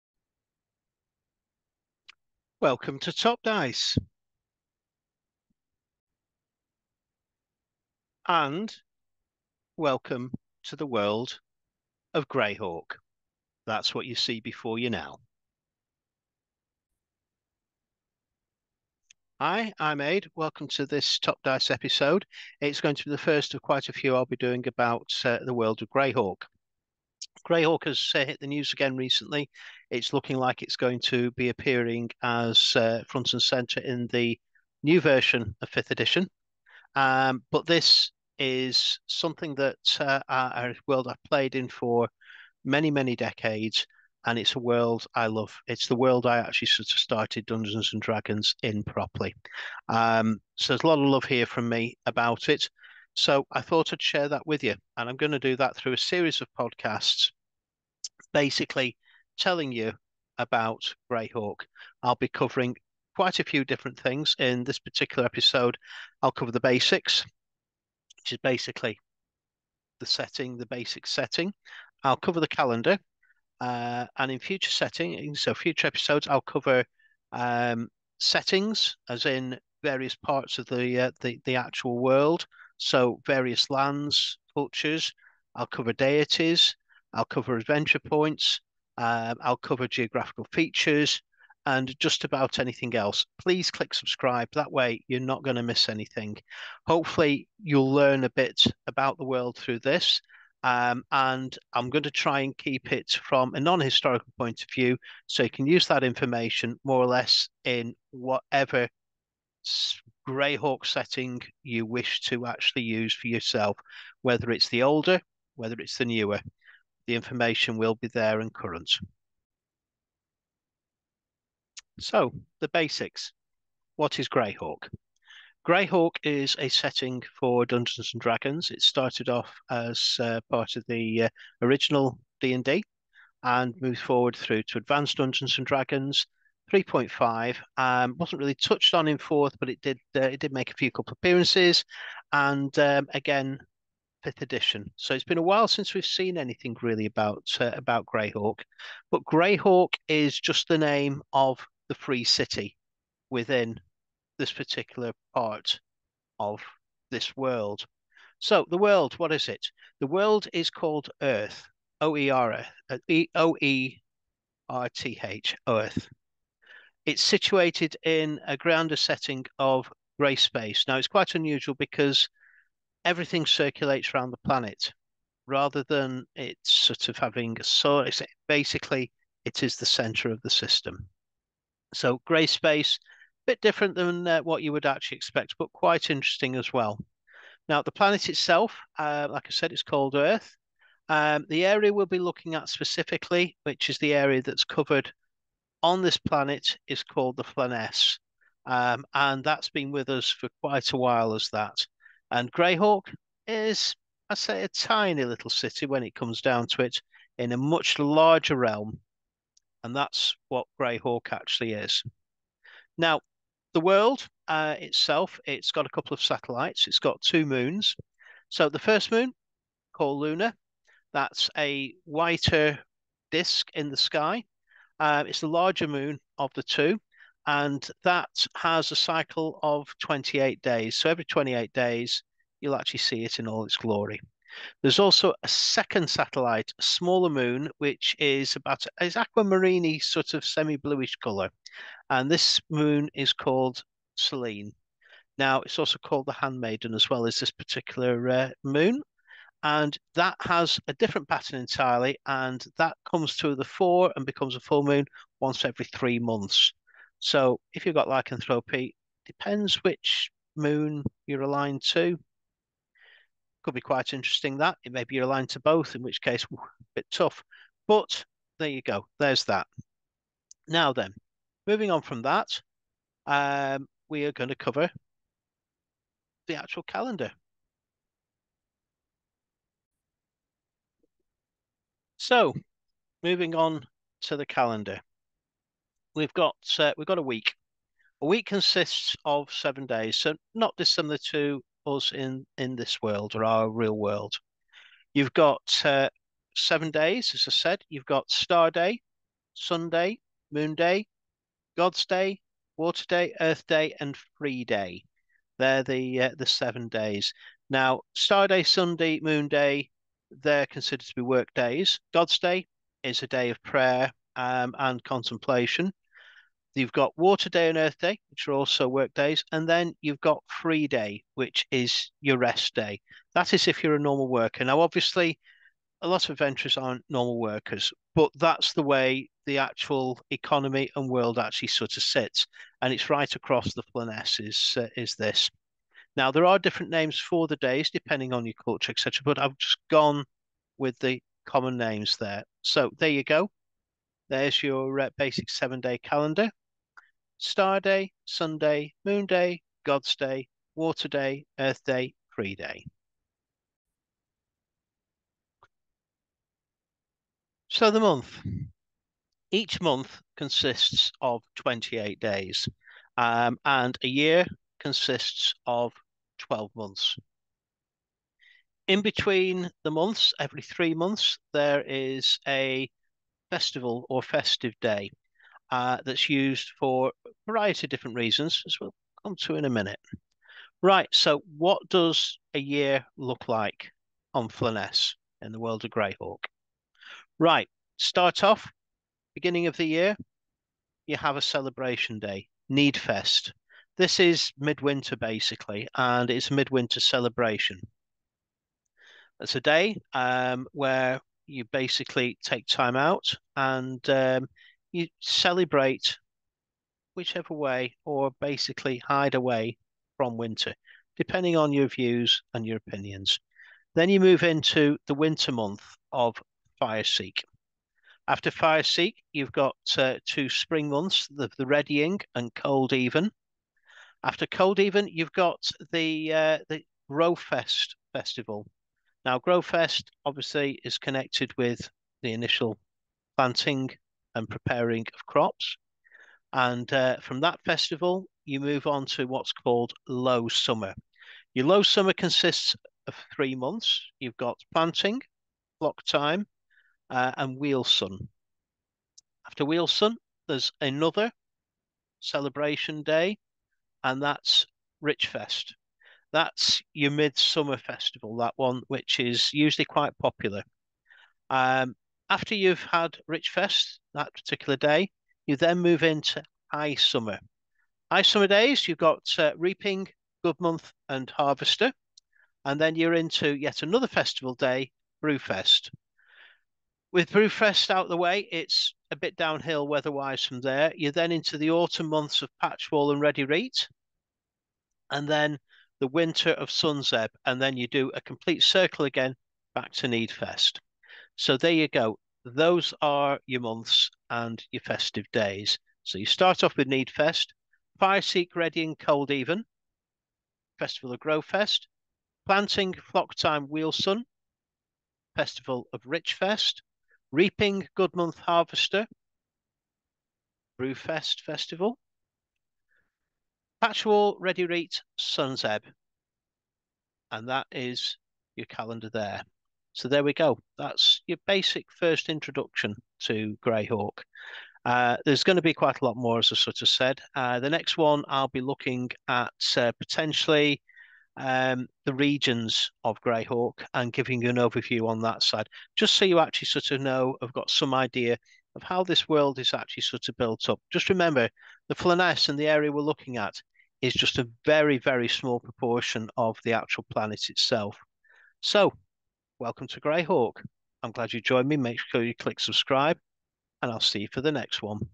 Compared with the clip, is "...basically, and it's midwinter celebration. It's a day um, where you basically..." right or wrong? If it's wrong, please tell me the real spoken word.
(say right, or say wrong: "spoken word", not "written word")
right.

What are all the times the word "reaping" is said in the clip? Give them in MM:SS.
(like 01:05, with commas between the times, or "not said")
07:49, 08:27.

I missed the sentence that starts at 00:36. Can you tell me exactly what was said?
Um, but this is something that uh, a world I've played in for many, many decades.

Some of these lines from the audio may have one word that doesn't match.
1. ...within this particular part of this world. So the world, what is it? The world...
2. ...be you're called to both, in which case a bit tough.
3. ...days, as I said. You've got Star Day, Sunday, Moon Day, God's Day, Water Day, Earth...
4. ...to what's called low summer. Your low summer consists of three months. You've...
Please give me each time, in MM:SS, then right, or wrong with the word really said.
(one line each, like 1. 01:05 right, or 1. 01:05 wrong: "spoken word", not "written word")
1. 02:33 right
2. 04:25 wrong: "aligned", not "called"
3. 04:56 right
4. 07:19 right.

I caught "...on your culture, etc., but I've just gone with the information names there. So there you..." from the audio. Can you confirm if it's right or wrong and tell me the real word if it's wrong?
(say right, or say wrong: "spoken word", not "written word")
wrong: "common", not "information".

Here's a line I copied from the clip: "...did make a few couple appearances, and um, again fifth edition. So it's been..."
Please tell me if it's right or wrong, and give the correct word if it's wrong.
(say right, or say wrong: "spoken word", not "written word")
right.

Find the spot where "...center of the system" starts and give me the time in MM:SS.
02:59.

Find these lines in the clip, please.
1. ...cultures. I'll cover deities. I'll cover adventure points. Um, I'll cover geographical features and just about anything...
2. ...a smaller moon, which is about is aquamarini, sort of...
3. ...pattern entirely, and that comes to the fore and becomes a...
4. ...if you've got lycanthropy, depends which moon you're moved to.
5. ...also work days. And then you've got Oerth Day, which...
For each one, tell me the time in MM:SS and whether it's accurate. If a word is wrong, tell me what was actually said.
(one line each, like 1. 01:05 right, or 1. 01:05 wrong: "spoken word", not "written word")
1. 01:24 right
2. 03:56 right
3. 04:11 right
4. 04:17 wrong: "aligned", not "moved"
5. 05:18 wrong: "Free", not "Oerth".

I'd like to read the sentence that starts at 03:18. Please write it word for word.
Um, and that's been with us for quite a while as that.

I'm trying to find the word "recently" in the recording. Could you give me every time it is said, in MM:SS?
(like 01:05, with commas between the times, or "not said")
00:28.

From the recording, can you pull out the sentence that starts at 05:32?
And it's right across the planet is, uh, is this.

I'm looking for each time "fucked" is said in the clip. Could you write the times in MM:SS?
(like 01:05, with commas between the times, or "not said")
not said.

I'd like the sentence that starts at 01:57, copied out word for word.
The information will be there and current.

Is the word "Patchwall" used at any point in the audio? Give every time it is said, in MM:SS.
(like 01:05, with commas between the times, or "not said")
08:02, 08:33.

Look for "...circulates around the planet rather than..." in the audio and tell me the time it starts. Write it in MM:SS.
02:53.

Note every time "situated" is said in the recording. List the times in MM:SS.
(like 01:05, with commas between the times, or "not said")
02:47.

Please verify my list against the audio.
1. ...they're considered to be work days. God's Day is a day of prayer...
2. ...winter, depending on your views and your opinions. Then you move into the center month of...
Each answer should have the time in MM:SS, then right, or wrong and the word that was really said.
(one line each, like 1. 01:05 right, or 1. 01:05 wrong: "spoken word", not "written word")
1. 05:10 right
2. 06:50 wrong: "winter", not "center".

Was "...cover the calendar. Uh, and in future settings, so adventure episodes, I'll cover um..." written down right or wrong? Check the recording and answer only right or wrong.
wrong.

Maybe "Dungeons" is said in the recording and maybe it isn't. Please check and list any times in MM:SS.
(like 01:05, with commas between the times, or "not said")
00:47, 02:07, 02:15.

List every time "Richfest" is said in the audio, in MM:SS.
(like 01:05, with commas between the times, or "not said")
07:35, 07:43, 08:26.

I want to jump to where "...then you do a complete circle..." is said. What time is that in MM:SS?
08:07.